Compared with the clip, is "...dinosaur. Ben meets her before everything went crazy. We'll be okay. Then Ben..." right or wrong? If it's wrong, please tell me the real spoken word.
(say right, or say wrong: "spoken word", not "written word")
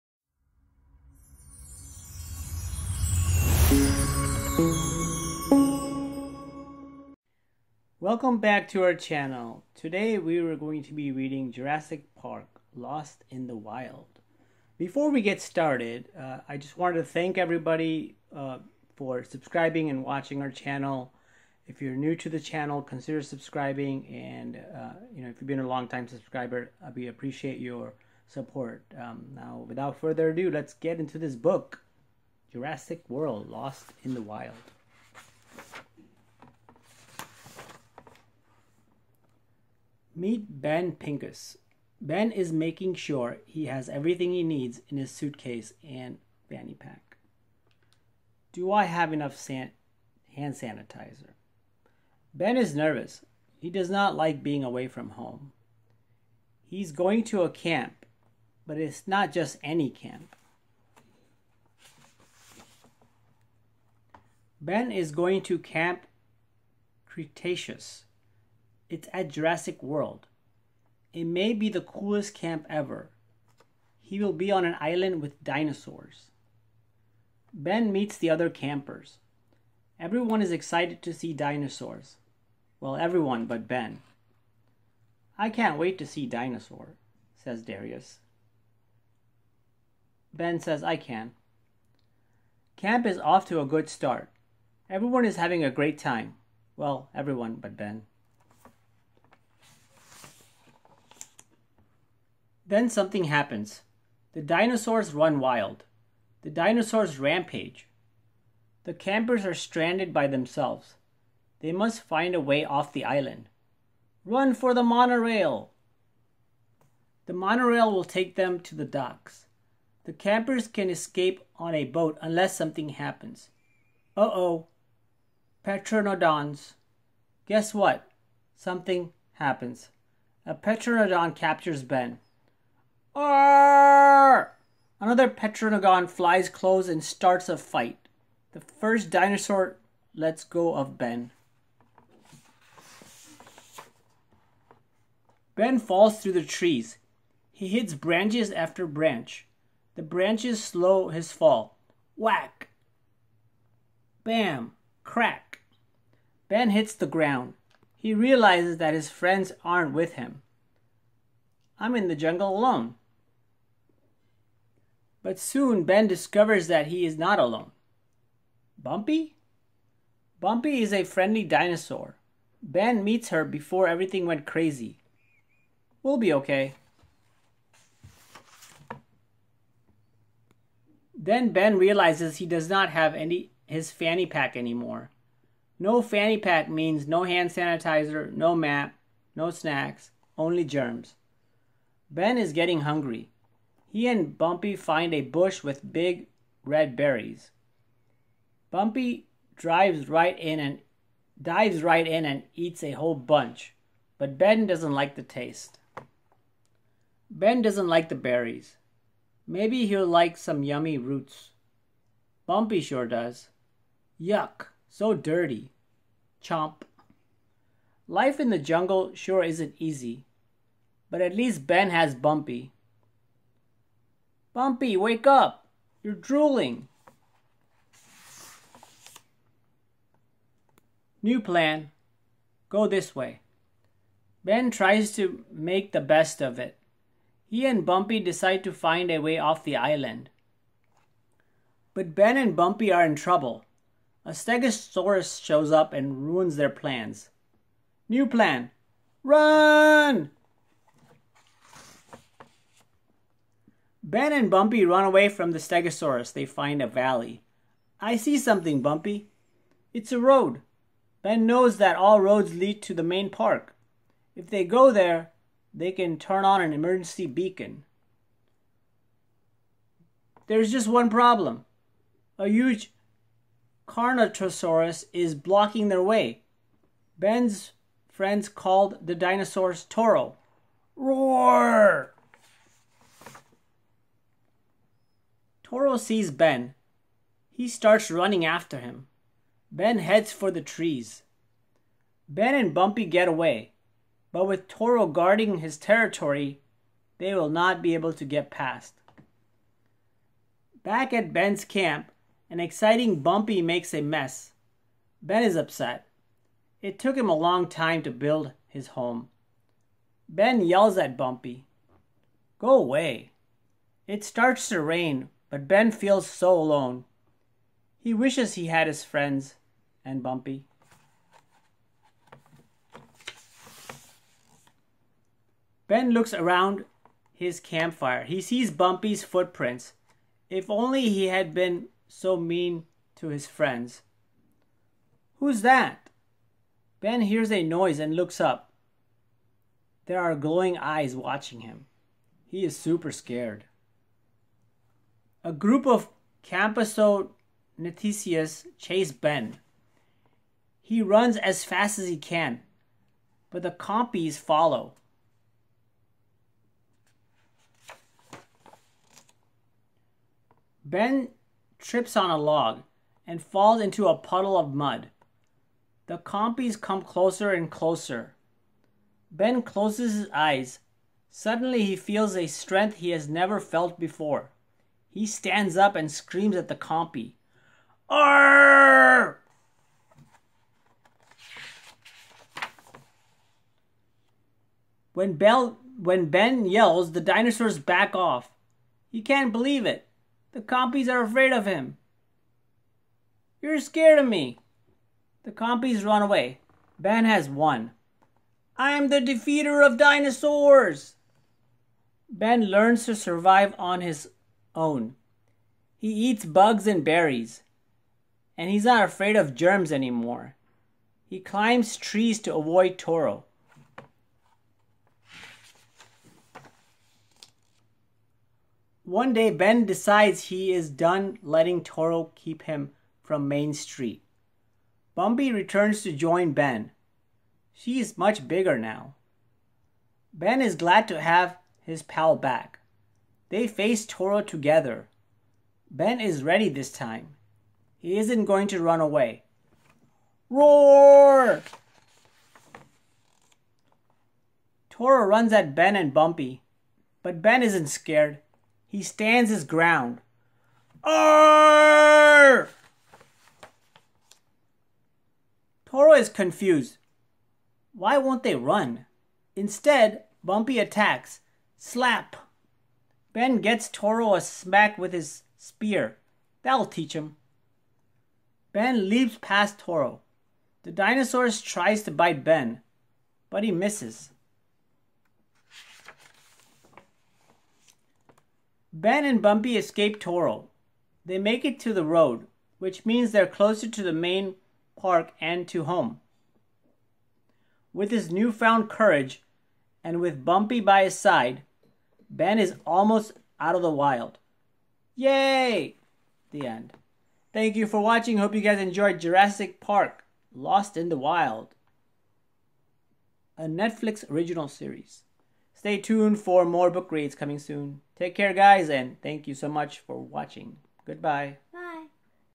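right.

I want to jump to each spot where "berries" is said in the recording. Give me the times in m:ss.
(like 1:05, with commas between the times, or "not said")
3:16, 3:28, 6:47.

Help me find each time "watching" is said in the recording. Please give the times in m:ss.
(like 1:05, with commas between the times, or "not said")
0:20, 5:41, 8:17, 8:30.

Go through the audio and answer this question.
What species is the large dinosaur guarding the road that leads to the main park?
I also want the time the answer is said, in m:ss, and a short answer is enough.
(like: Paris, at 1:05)
Carnotaurus, at 4:33.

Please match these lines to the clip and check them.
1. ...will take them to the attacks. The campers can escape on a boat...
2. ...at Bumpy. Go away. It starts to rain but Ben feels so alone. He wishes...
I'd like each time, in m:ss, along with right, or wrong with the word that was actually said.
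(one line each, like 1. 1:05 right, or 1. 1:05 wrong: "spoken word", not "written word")
1. 1:57 wrong: "docks", not "attacks"
2. 5:10 right.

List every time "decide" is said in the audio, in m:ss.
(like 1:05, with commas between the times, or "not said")
3:58, 6:59.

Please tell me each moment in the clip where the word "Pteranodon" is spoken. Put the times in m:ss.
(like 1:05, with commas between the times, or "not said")
2:05, 2:10, 2:15.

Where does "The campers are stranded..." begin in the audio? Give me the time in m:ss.
1:48.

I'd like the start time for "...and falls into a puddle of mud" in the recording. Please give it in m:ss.
6:03.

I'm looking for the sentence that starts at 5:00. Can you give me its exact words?
Back at Ben's camp, an exciting Bumpy makes a mess.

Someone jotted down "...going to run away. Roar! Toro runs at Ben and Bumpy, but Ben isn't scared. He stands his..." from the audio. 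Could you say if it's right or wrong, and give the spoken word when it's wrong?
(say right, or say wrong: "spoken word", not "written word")
right.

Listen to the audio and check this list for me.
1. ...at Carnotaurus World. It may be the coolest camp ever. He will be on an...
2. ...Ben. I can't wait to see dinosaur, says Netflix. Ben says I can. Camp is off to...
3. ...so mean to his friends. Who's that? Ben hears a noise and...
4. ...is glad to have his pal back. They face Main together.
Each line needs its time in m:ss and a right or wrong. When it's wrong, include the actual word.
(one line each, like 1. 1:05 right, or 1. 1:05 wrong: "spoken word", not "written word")
1. 1:09 wrong: "Jurassic", not "Carnotaurus"
2. 1:23 wrong: "Darius", not "Netflix"
3. 5:32 right
4. 7:10 wrong: "Toro", not "Main".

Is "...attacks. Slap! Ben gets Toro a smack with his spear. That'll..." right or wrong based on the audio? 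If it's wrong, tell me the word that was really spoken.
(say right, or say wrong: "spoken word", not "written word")
right.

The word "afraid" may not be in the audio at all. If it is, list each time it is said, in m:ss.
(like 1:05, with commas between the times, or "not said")
6:31, 6:49.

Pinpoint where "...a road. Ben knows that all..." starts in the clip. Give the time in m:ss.
4:20.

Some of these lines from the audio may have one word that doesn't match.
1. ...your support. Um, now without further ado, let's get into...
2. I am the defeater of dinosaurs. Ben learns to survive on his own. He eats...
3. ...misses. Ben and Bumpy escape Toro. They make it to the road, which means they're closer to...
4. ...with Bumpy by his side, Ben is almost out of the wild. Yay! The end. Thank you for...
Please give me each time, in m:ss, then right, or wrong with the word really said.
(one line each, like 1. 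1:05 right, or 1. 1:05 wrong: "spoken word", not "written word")
1. 0:27 right
2. 6:38 right
3. 7:53 right
4. 8:10 right.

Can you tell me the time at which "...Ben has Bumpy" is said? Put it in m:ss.
3:41.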